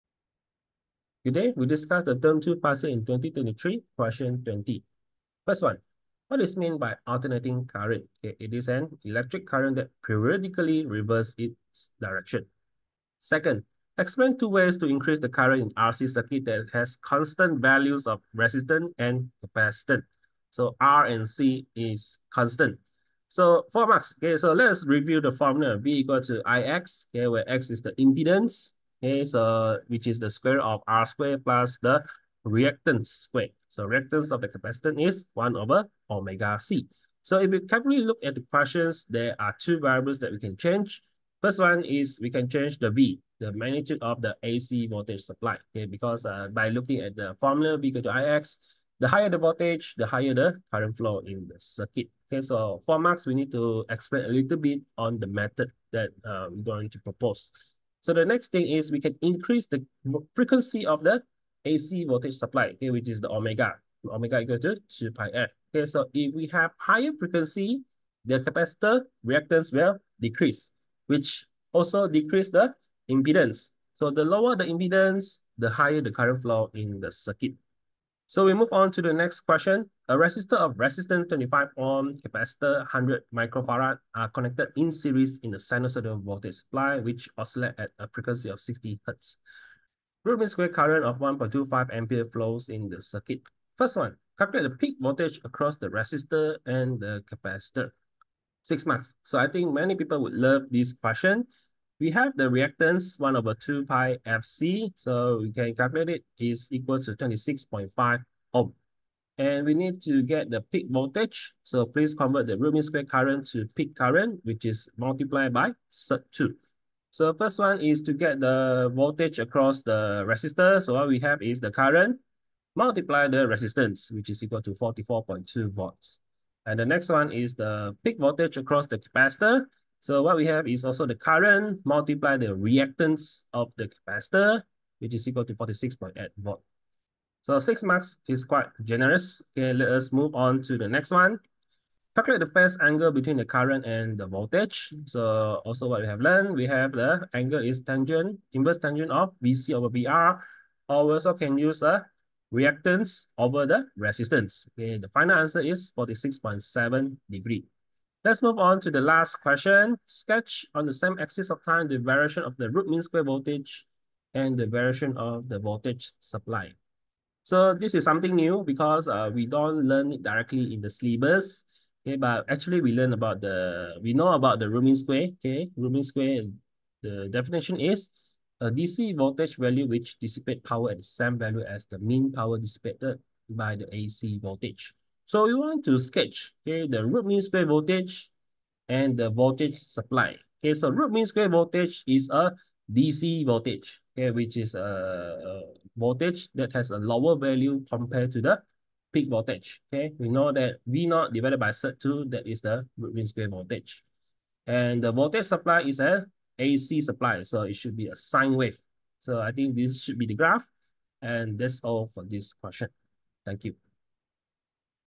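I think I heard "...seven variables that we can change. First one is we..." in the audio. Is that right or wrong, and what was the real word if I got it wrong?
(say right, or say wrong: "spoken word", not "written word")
wrong: "two", not "seven".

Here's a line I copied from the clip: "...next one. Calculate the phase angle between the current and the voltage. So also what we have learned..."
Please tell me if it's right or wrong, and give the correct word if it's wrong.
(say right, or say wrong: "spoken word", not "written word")
right.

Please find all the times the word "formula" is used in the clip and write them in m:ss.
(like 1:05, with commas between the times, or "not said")
0:25, 0:47.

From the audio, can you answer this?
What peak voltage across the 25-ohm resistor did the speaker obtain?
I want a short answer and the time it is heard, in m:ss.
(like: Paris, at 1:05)
44.2 volts, at 2:04.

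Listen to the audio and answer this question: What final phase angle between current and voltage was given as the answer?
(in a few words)
46.7 degrees.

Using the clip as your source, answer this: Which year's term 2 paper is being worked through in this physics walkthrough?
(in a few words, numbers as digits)
2023.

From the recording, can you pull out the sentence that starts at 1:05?
Okay, so if we have higher frequency, the capacitor reactance will decrease, which also decrease the impedance.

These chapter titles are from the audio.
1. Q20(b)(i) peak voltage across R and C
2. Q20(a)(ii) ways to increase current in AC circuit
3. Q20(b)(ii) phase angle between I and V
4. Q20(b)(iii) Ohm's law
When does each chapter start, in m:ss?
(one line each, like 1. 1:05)
1. 1:19
2. 0:13
3. 2:21
4. 2:40.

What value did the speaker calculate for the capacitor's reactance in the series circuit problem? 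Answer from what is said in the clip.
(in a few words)
26.5 ohm.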